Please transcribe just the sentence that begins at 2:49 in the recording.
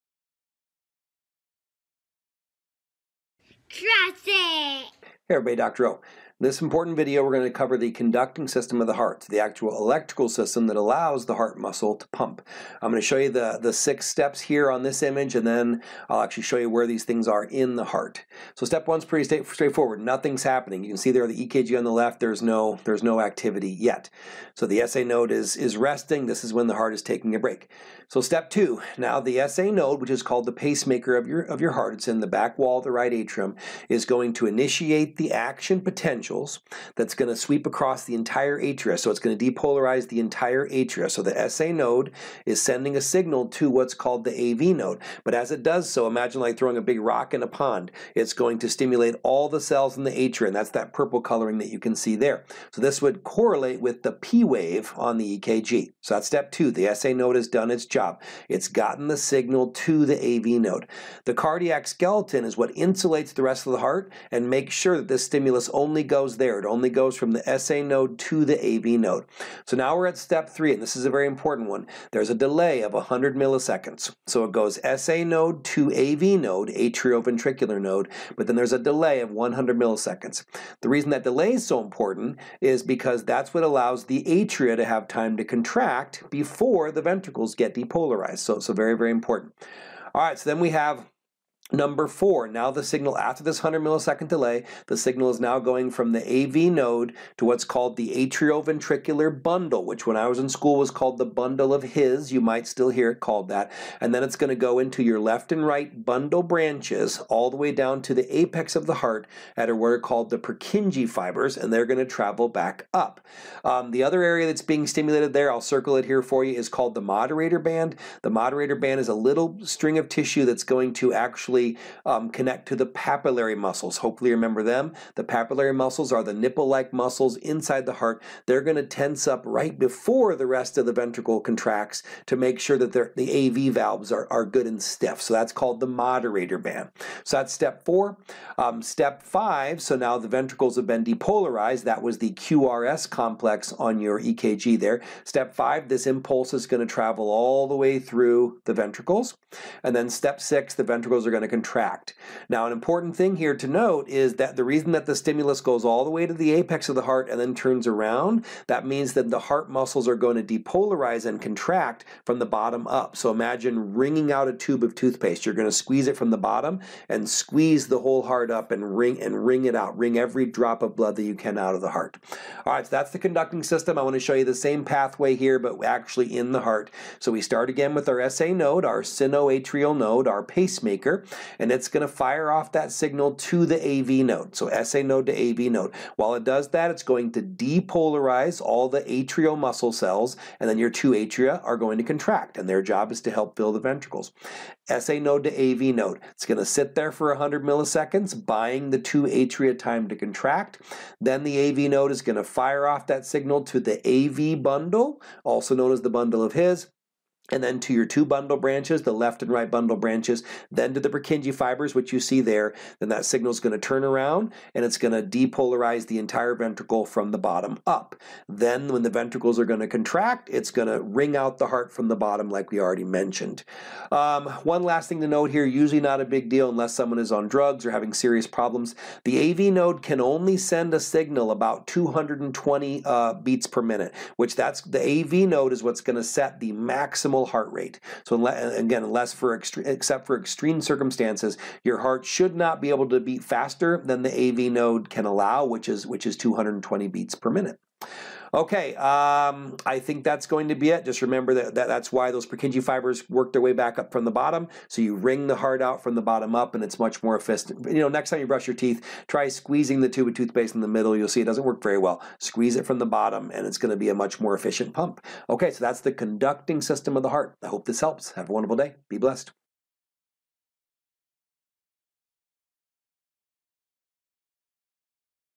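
Wring every drop of blood that you can out of the heart.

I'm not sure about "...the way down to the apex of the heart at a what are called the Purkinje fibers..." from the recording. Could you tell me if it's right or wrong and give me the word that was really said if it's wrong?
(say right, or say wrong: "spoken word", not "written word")
right.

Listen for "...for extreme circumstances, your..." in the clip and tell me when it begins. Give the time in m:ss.
4:00.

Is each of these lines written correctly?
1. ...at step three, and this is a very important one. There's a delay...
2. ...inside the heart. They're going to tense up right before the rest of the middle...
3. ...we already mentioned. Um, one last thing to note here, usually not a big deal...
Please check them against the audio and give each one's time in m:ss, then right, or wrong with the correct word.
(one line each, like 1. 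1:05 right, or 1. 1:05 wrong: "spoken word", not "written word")
1. 1:10 right
2. 2:07 wrong: "ventricle", not "middle"
3. 3:42 right.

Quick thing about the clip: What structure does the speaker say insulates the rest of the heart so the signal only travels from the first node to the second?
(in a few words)
Cardiac skeleton.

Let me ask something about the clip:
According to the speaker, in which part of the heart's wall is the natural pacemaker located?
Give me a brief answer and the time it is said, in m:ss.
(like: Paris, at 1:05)
Back wall of the right atrium, at 0:32.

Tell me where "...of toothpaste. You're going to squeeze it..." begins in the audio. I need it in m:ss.
2:44.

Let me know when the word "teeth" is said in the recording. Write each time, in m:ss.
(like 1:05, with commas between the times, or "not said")
4:18.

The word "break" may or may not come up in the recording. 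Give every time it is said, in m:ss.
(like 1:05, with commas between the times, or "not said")
0:27.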